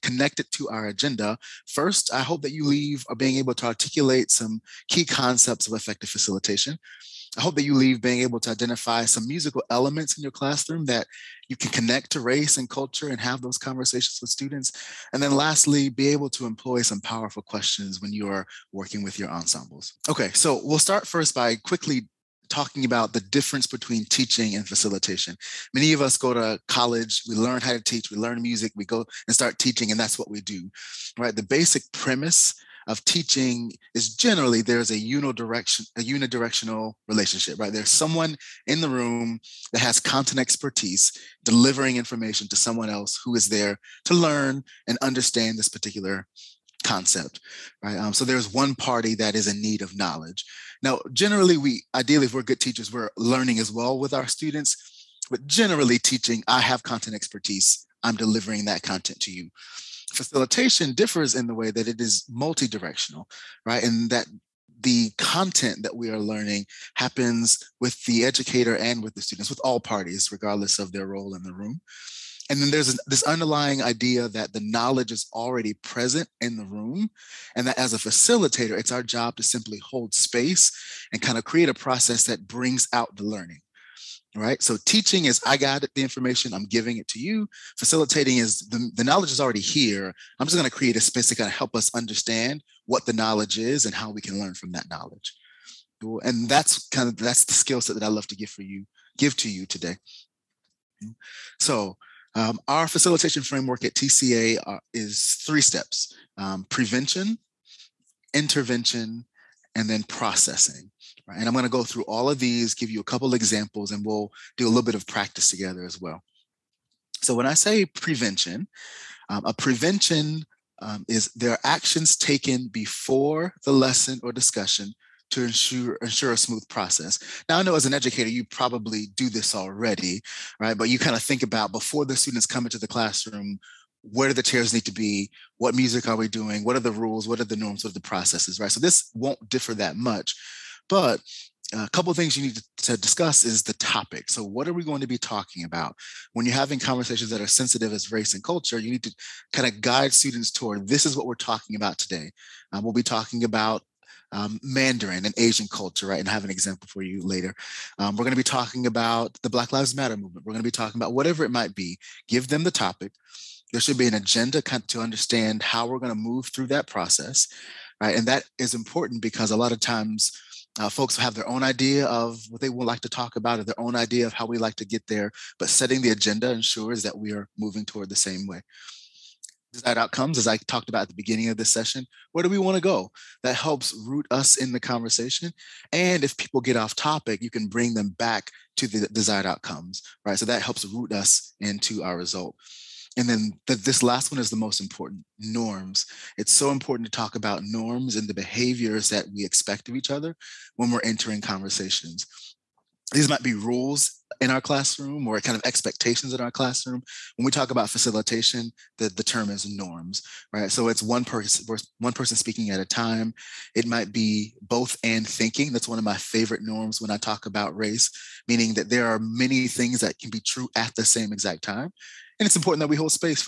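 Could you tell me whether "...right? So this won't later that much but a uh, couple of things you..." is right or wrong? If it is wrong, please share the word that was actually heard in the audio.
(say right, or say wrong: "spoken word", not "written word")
wrong: "differ", not "later".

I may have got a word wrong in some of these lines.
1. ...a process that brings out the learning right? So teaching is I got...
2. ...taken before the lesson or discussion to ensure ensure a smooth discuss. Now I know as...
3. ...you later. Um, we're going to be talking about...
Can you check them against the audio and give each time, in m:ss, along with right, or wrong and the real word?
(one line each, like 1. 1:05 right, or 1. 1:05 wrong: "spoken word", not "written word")
1. 1:21 right
2. 2:02 wrong: "process", not "discuss"
3. 2:37 right.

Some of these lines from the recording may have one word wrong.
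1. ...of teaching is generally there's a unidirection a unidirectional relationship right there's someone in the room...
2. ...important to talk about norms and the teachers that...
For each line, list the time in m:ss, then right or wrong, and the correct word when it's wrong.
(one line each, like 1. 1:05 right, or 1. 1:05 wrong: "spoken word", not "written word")
1. 0:32 right
2. 3:16 wrong: "behaviors", not "teachers".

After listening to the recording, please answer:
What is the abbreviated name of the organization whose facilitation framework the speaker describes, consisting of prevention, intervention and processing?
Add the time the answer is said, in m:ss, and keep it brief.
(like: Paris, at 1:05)
TCA, at 1:43.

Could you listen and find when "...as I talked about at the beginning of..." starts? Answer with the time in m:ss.
3:00.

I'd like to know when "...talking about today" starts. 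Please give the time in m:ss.
2:31.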